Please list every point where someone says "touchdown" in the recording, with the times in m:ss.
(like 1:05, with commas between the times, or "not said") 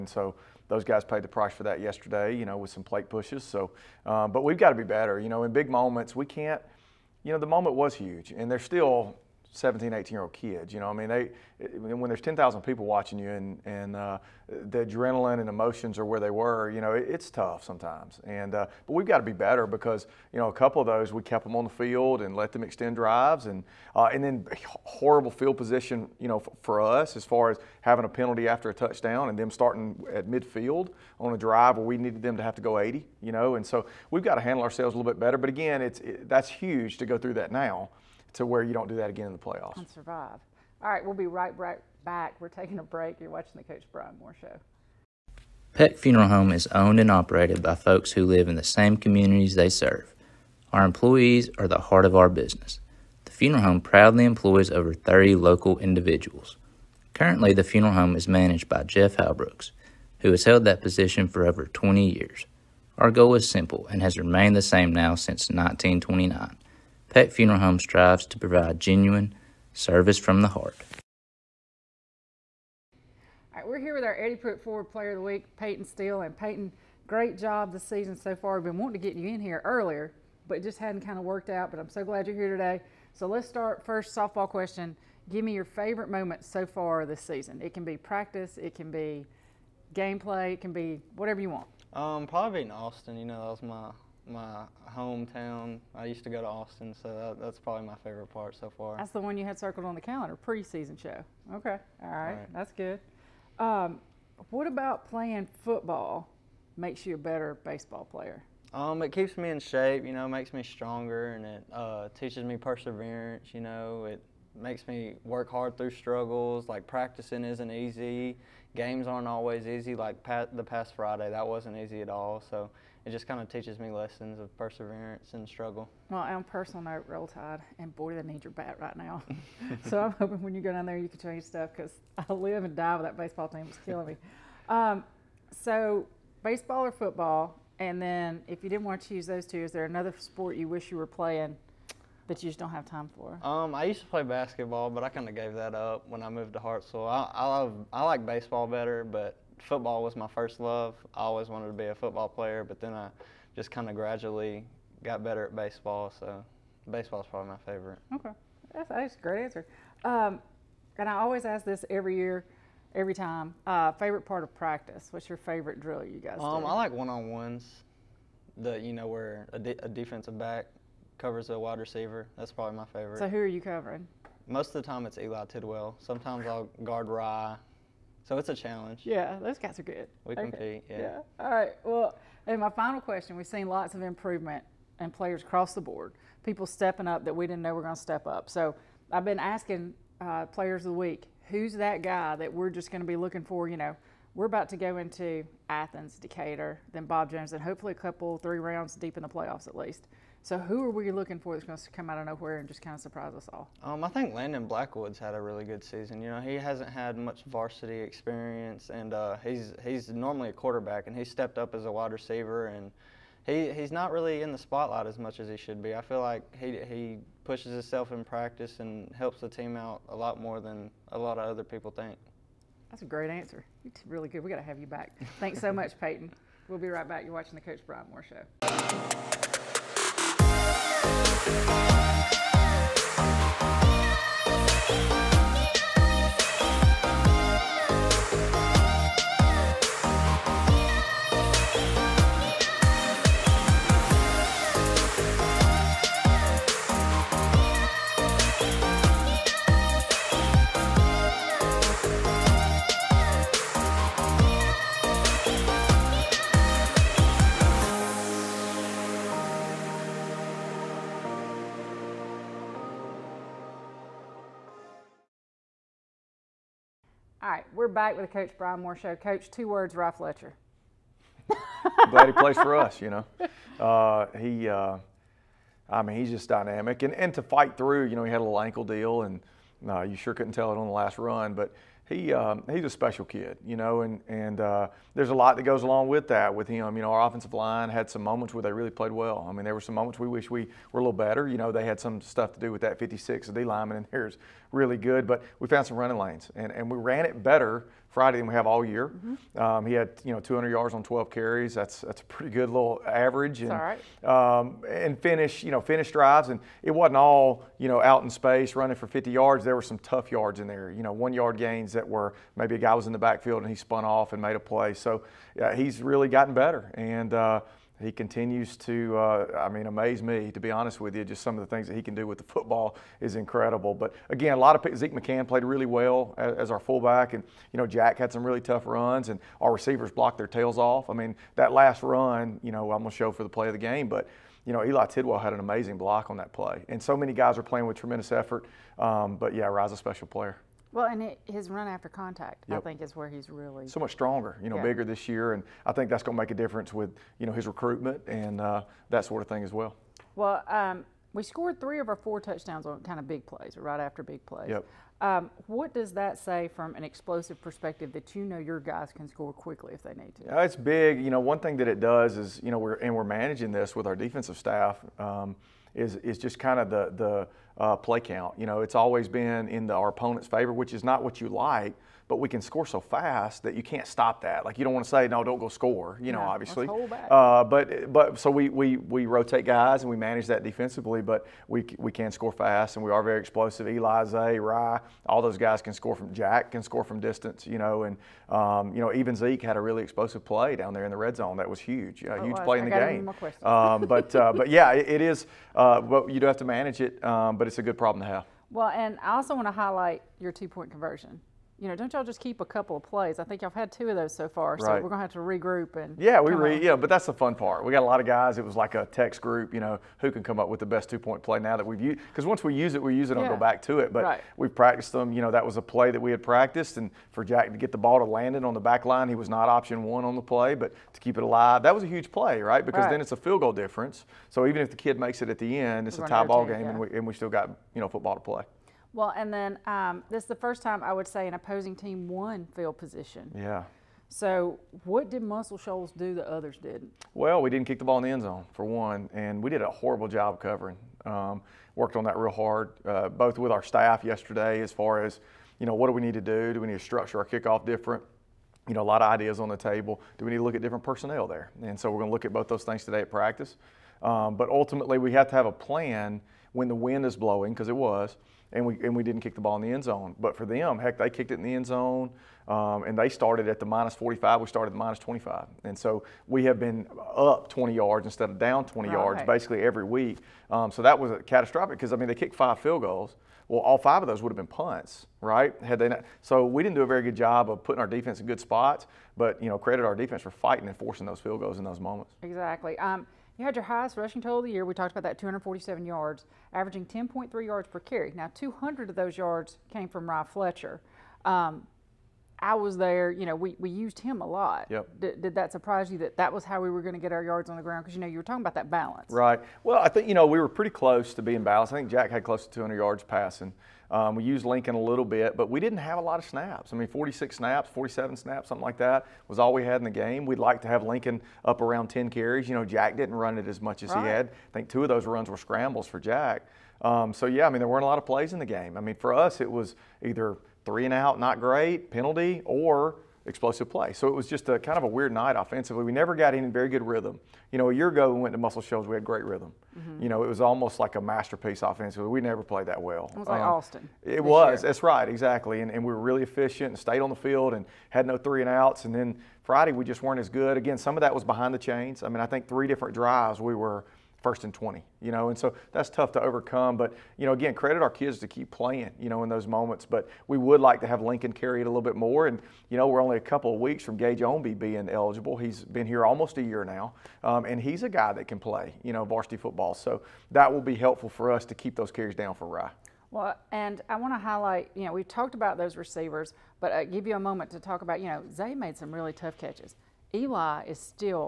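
0:28, 5:52.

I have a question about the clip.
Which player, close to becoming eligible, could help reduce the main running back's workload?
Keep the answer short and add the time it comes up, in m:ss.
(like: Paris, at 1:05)
Gage Omby, at 9:14.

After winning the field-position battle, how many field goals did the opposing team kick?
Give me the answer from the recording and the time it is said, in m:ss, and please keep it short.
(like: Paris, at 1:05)
5, at 7:52.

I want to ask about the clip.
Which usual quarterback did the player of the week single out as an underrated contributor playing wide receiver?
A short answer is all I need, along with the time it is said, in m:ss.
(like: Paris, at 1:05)
Landon Blackwood, at 3:24.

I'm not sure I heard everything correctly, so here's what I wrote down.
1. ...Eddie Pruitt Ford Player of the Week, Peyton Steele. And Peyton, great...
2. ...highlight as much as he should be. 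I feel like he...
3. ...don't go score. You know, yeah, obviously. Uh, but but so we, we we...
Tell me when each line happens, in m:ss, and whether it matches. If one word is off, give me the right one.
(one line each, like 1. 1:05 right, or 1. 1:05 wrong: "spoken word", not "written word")
1. 1:14 right
2. 3:34 wrong: "spotlight", not "highlight"
3. 6:15 right.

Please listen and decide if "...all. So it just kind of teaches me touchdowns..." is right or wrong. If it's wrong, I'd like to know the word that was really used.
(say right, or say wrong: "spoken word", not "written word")
wrong: "lessons", not "touchdowns".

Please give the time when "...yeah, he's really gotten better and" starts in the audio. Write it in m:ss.
5:15.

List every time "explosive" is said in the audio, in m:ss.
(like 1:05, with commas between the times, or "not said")
5:57, 6:23, 6:30, 8:43.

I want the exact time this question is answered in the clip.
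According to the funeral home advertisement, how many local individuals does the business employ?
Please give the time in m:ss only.
0:54.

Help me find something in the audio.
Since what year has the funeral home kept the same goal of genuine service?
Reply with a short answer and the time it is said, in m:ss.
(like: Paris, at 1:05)
1929, at 1:05.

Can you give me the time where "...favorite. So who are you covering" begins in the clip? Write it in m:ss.
2:52.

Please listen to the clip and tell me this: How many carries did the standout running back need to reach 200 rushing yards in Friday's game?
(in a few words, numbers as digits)
12.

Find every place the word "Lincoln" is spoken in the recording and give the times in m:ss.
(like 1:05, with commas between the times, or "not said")
8:24, 8:31, 9:11.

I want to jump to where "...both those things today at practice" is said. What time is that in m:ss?
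7:32.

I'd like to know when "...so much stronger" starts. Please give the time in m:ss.
5:43.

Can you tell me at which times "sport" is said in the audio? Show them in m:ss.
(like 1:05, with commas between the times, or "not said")
2:20.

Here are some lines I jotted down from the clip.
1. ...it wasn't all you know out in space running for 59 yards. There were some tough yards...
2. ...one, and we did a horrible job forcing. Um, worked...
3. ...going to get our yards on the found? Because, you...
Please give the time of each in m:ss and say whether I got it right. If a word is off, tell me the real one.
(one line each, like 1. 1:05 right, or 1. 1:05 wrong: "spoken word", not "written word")
1. 5:06 wrong: "50", not "59"
2. 7:18 wrong: "covering", not "forcing"
3. 8:17 wrong: "ground", not "found".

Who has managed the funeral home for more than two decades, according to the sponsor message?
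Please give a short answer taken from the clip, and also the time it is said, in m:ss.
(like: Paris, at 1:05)
Jeff Halbrooks, at 0:58.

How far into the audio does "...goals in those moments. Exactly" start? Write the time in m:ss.
8:01.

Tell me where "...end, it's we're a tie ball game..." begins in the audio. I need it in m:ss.
7:05.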